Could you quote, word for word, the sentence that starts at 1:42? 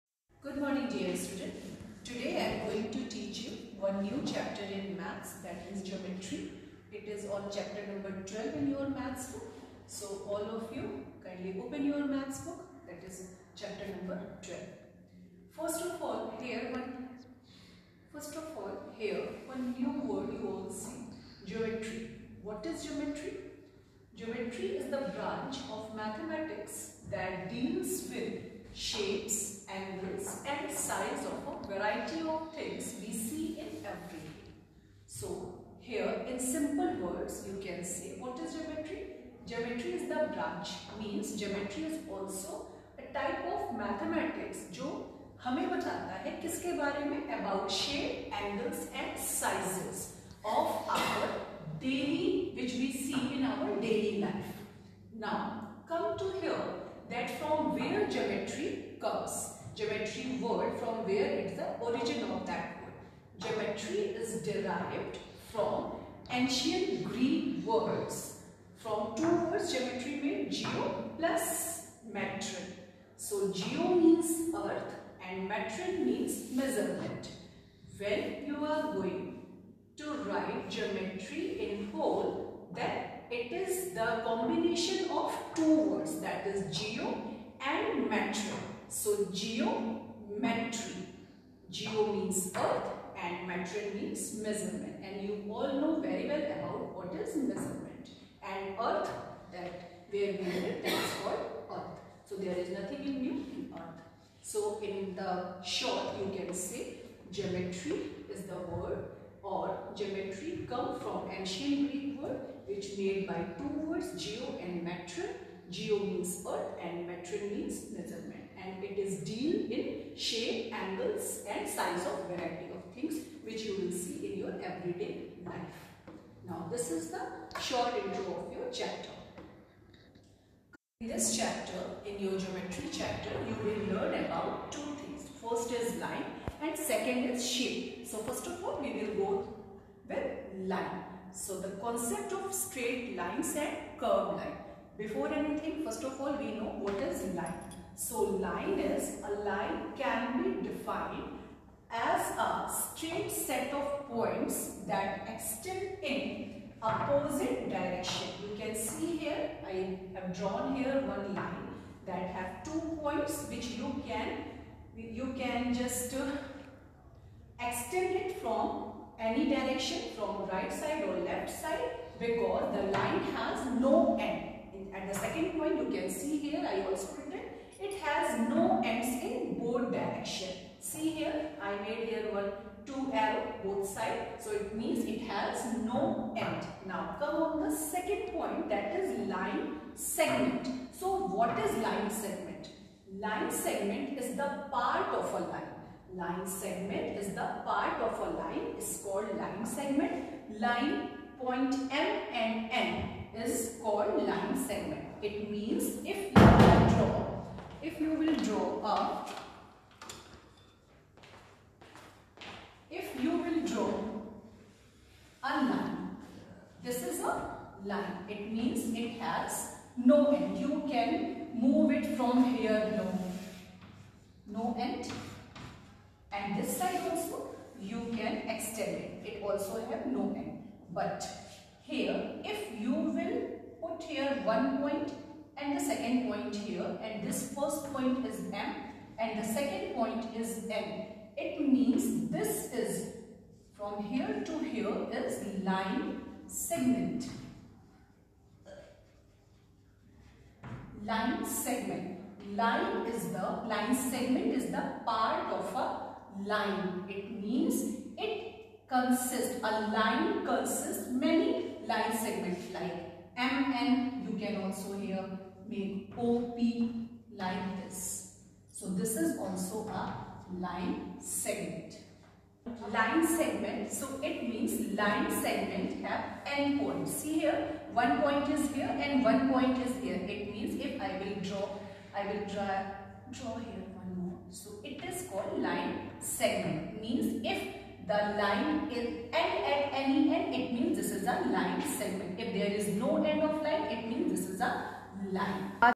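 So there is nothing in new in earth.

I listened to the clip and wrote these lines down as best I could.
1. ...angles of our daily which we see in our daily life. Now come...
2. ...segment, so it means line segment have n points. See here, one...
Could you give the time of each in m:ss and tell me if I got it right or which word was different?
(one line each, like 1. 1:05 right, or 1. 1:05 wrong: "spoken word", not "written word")
1. 0:49 wrong: "sizes", not "angles"
2. 4:33 right.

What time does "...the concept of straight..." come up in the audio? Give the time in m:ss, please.
2:21.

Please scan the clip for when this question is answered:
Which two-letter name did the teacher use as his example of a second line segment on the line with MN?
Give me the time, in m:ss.
4:26.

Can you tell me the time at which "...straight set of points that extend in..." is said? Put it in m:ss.
2:32.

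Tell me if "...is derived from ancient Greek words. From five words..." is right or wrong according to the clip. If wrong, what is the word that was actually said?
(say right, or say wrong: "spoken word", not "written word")
wrong: "two", not "five".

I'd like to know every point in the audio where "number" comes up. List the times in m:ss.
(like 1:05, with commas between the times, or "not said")
0:07, 0:13.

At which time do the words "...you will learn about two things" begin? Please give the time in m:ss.
2:13.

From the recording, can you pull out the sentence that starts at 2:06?
Now this is the short intro of your chapter.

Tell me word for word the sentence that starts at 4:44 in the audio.
So it is called line segment.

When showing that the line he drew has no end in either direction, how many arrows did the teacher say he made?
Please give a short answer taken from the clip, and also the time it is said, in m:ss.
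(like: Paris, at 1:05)
2, at 3:02.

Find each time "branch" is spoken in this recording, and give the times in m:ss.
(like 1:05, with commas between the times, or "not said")
0:25, 0:40.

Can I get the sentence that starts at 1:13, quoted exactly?
So geo means earth and metron means measurement.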